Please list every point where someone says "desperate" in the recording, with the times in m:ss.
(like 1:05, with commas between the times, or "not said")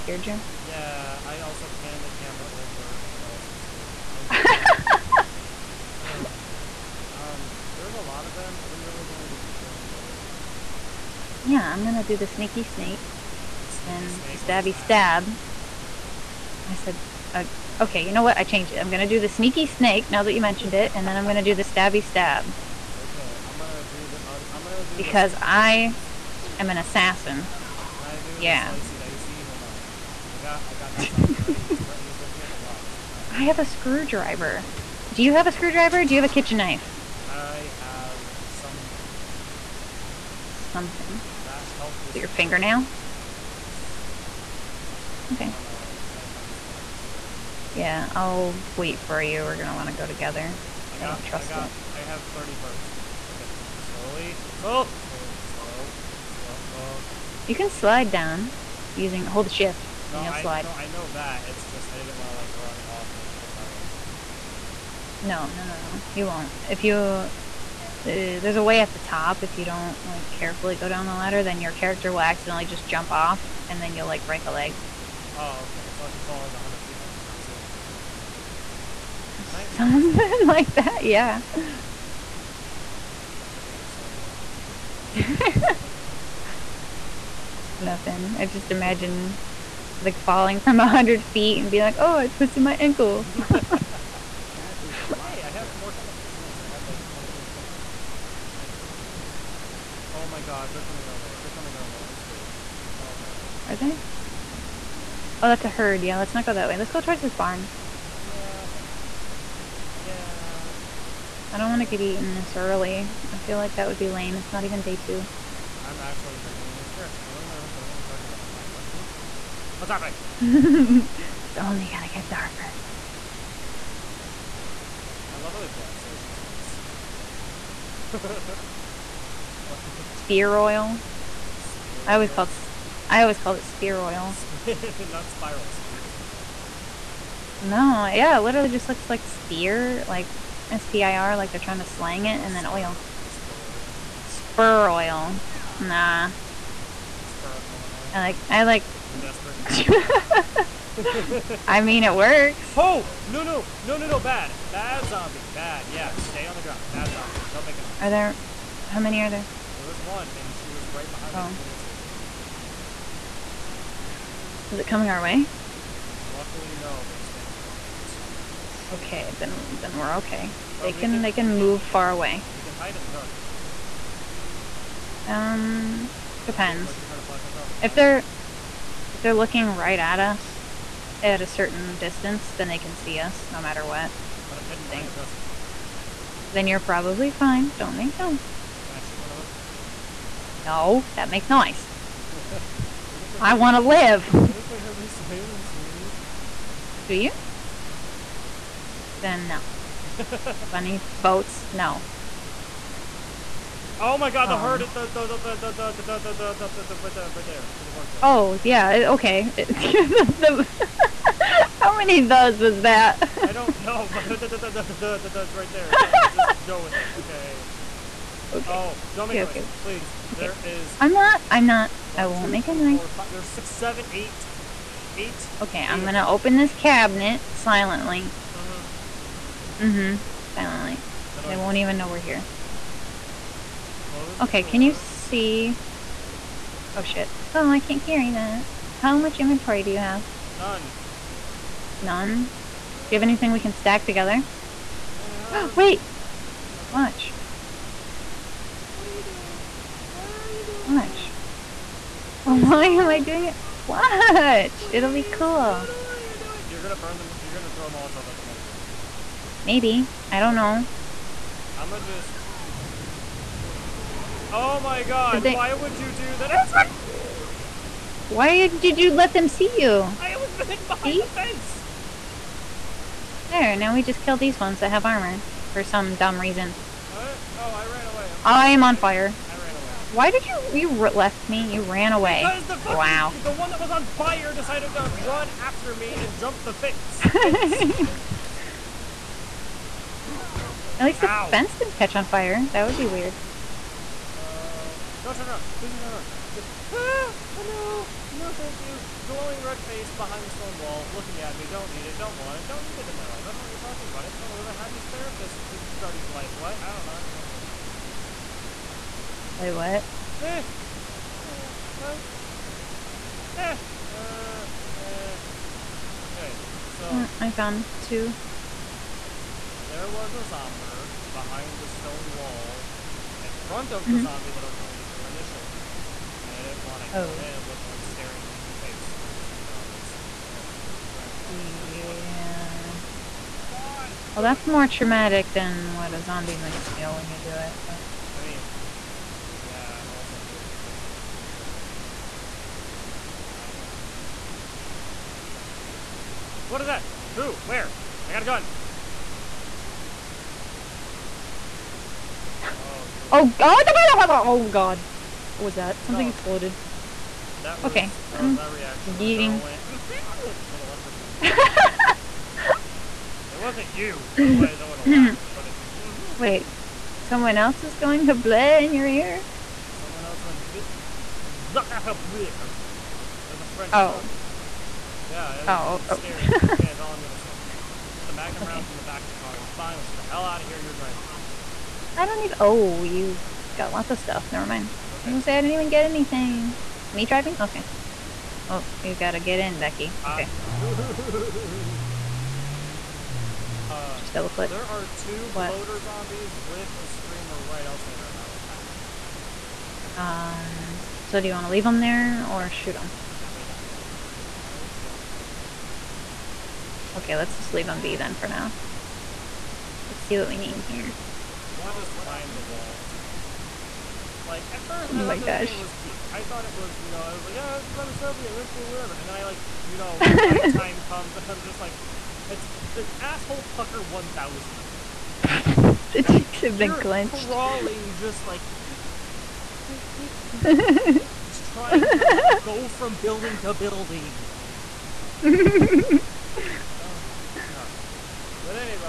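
2:29.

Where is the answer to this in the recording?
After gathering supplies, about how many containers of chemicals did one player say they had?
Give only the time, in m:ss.
1:37.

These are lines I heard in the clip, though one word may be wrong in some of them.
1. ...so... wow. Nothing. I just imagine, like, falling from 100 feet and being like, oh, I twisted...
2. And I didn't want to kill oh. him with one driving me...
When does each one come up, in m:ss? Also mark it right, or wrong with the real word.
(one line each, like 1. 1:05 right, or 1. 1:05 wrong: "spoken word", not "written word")
1. 1:23 right
2. 5:26 wrong: "staring", not "driving".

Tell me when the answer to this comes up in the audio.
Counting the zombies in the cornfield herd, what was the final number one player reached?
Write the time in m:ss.
3:44.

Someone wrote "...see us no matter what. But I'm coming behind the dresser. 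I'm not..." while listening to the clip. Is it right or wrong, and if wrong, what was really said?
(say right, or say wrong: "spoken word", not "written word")
wrong: "heading", not "coming".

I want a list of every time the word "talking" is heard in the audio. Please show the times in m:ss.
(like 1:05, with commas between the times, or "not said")
1:58, 5:03.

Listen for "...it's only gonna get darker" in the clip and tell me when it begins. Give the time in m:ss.
2:01.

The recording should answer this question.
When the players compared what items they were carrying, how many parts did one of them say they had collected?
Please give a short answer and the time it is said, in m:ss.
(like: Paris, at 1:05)
30, at 0:51.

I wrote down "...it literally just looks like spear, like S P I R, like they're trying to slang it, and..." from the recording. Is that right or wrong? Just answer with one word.
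right.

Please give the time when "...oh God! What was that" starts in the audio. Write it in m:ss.
5:54.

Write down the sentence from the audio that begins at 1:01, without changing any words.
It's just I didn't want to like run off of the tower because you know that'd be dumb.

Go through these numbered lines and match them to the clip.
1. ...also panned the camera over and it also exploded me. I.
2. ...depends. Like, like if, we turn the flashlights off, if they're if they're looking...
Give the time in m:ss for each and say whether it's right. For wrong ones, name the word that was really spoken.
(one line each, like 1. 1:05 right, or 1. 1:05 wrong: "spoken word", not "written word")
1. 0:01 wrong: "scared", not "exploded"
2. 2:56 right.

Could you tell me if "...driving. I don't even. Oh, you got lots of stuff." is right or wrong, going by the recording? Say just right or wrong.
right.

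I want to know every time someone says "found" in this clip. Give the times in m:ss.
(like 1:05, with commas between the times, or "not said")
5:17.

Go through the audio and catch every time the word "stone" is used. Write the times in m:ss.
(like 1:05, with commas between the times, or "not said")
5:00, 5:21.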